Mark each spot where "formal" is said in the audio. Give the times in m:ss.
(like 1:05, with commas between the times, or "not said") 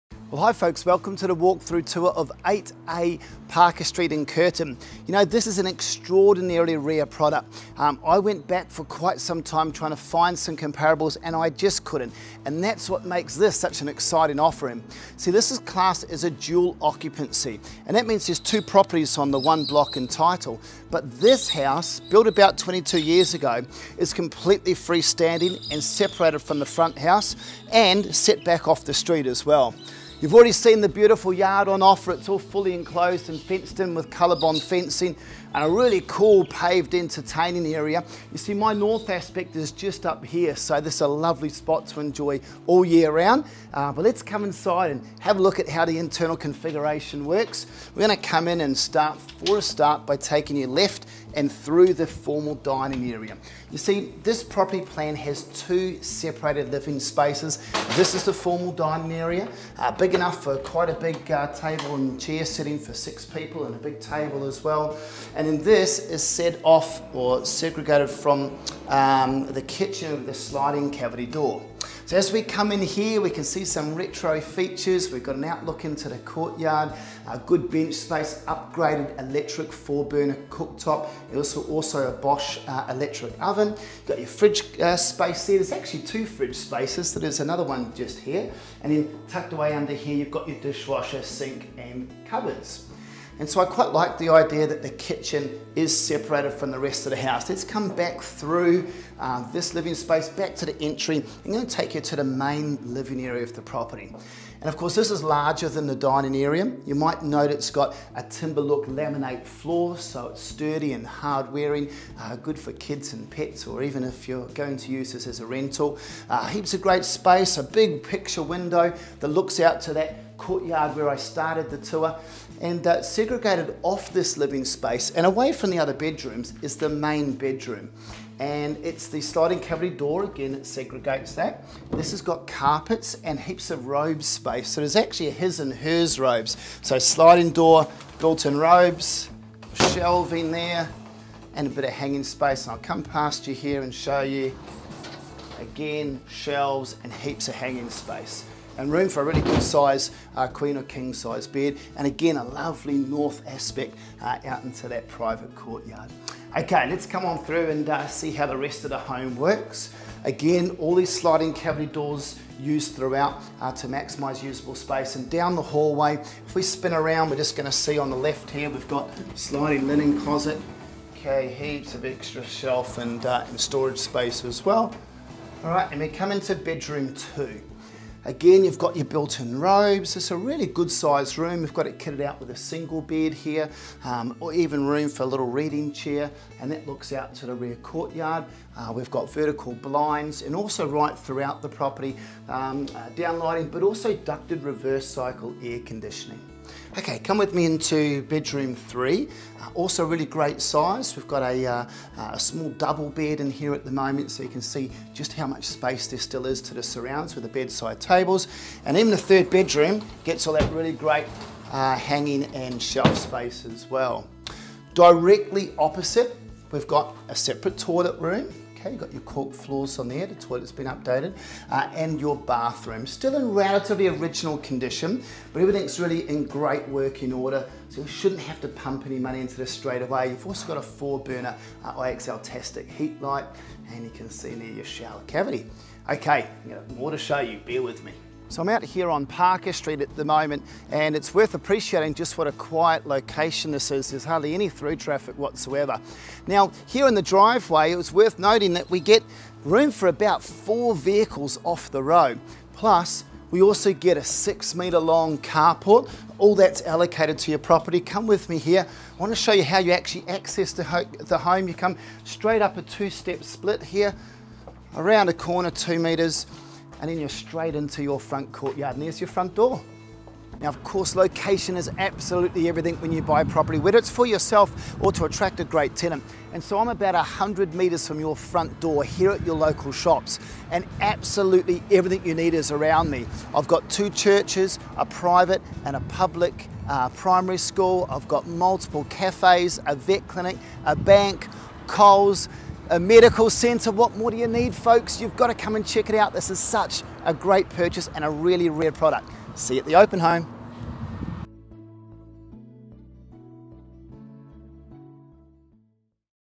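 0:52, 0:58.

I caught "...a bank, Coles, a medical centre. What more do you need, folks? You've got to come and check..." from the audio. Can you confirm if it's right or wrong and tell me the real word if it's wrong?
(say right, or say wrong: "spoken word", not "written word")
right.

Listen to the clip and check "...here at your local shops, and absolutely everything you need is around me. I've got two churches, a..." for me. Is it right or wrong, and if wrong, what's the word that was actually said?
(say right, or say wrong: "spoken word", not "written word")
right.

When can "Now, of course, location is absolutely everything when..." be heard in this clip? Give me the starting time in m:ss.
4:30.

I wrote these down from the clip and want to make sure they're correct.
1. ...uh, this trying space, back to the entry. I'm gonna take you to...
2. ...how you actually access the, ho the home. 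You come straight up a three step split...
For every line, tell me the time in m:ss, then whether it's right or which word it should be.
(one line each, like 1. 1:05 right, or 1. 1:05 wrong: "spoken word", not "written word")
1. 1:39 wrong: "living", not "trying"
2. 4:19 wrong: "two", not "three".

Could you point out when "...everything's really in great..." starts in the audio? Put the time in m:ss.
3:45.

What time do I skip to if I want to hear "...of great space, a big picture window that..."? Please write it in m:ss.
1:56.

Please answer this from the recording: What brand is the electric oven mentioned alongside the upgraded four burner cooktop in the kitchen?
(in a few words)
Bosch.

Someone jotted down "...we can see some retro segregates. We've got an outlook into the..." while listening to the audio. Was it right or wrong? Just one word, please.
wrong.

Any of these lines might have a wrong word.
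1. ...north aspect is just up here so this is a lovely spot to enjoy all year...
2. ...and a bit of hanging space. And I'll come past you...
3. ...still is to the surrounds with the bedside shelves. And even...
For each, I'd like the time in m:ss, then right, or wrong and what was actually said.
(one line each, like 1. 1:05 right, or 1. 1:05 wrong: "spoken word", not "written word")
1. 0:38 right
2. 2:21 right
3. 3:26 wrong: "tables", not "shelves".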